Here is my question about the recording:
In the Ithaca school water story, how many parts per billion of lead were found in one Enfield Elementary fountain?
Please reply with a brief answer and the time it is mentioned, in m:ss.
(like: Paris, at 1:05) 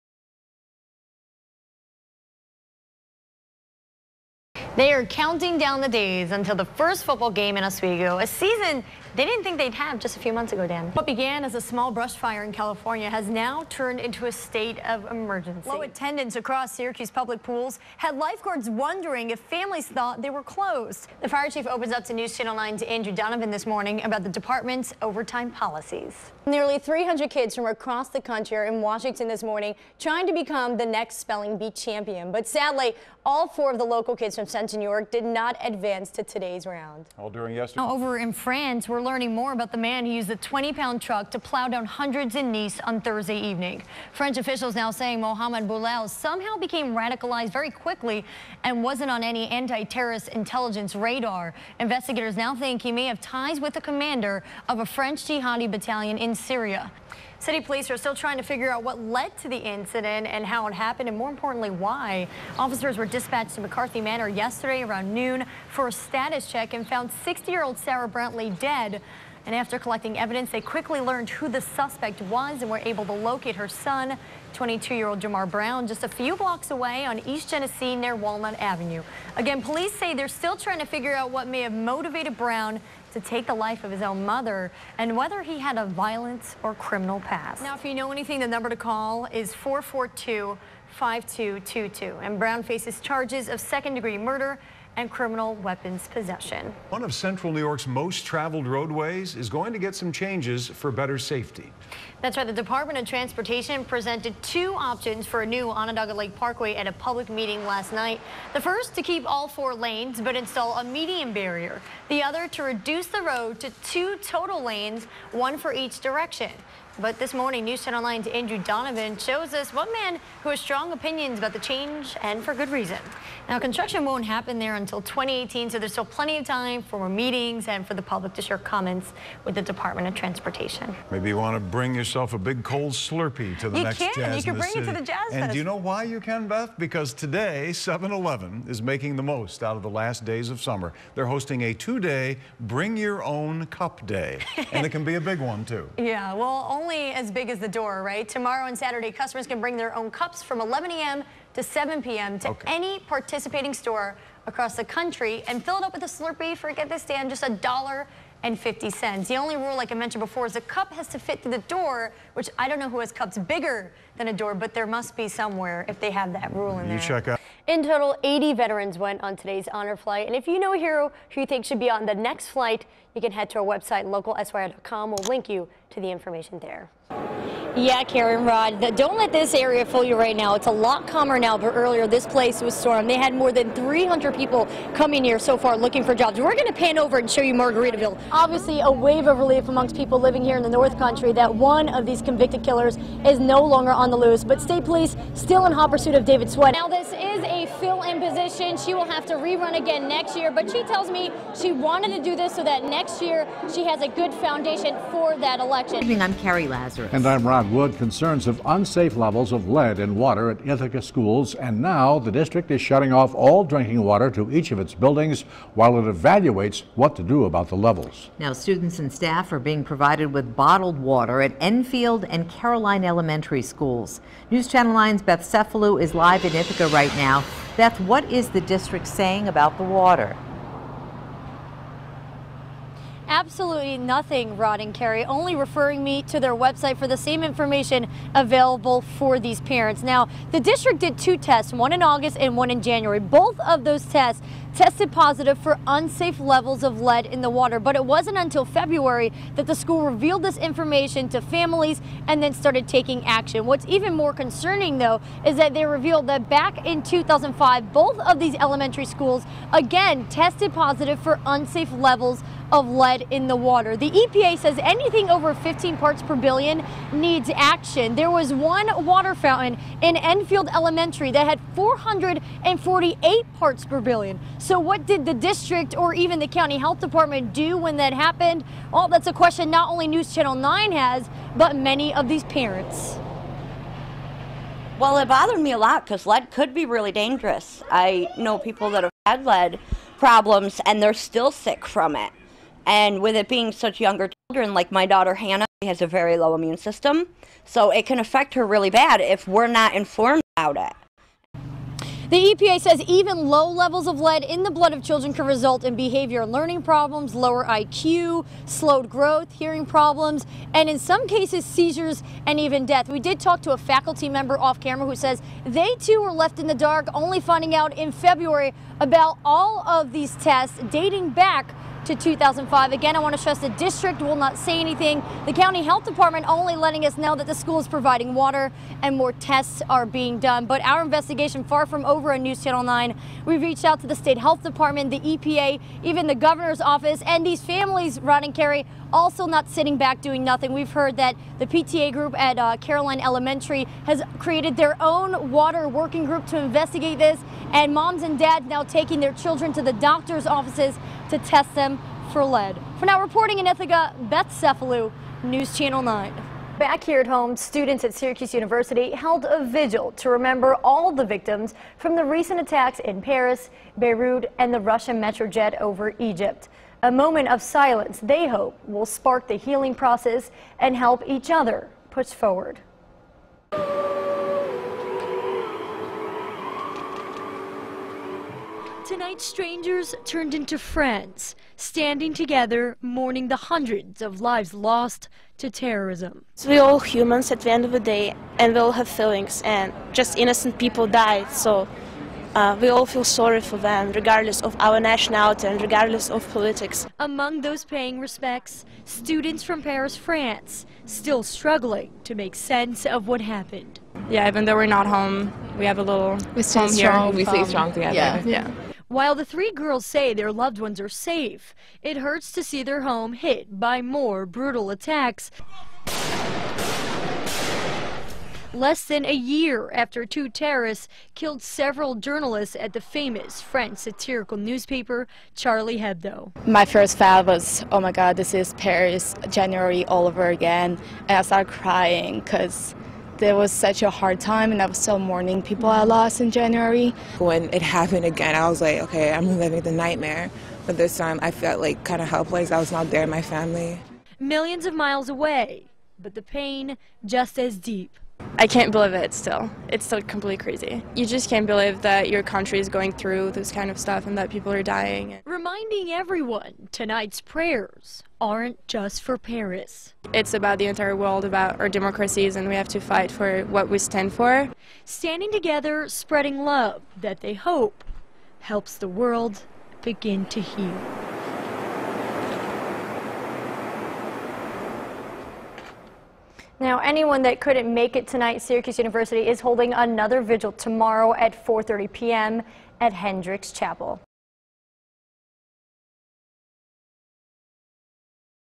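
448, at 4:31.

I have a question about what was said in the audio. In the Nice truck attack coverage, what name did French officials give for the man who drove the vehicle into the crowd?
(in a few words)
Mohamed Bouhlel.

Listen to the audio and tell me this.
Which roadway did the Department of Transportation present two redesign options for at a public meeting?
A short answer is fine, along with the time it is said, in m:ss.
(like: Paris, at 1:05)
Onondaga Lake Parkway, at 1:45.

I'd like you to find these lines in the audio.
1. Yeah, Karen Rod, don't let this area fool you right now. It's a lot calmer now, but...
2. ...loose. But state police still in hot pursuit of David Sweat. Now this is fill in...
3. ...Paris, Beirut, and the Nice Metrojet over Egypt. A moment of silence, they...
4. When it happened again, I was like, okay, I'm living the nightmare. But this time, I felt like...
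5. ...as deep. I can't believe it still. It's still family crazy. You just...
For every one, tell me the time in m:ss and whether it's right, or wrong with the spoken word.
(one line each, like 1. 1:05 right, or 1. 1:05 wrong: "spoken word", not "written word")
1. 2:57 right
2. 3:14 right
3. 6:03 wrong: "Russian", not "Nice"
4. 7:17 right
5. 7:27 wrong: "completely", not "family".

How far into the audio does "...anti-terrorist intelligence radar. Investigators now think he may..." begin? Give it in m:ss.
0:49.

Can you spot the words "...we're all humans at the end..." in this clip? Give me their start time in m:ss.
6:26.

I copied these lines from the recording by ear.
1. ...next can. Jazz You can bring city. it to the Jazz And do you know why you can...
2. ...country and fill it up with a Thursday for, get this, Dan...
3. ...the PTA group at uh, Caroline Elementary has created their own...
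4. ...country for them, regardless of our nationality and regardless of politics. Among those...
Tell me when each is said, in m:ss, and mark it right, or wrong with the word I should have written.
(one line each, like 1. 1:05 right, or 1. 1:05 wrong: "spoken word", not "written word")
1. 2:13 right
2. 2:34 wrong: "Slurpee", not "Thursday"
3. 5:41 right
4. 6:33 wrong: "sorry", not "country".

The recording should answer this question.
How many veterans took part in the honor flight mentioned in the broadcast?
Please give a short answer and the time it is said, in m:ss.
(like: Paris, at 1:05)
80, at 2:48.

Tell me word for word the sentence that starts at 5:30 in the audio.
But our investigation far from over on News Channel 9.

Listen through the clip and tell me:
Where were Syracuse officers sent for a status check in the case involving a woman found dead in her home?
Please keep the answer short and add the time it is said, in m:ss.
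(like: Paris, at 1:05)
McCarthy Manor, at 1:03.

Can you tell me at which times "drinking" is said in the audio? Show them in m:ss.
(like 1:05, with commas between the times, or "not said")
3:33.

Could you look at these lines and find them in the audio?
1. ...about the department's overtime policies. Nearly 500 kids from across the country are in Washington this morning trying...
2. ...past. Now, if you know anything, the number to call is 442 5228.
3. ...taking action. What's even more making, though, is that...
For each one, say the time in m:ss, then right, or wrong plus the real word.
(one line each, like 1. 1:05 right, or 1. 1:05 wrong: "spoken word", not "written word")
1. 0:24 wrong: "300", not "500"
2. 1:27 wrong: "5222", not "5228"
3. 4:12 wrong: "concerning", not "making".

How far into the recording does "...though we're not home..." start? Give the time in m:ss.
6:44.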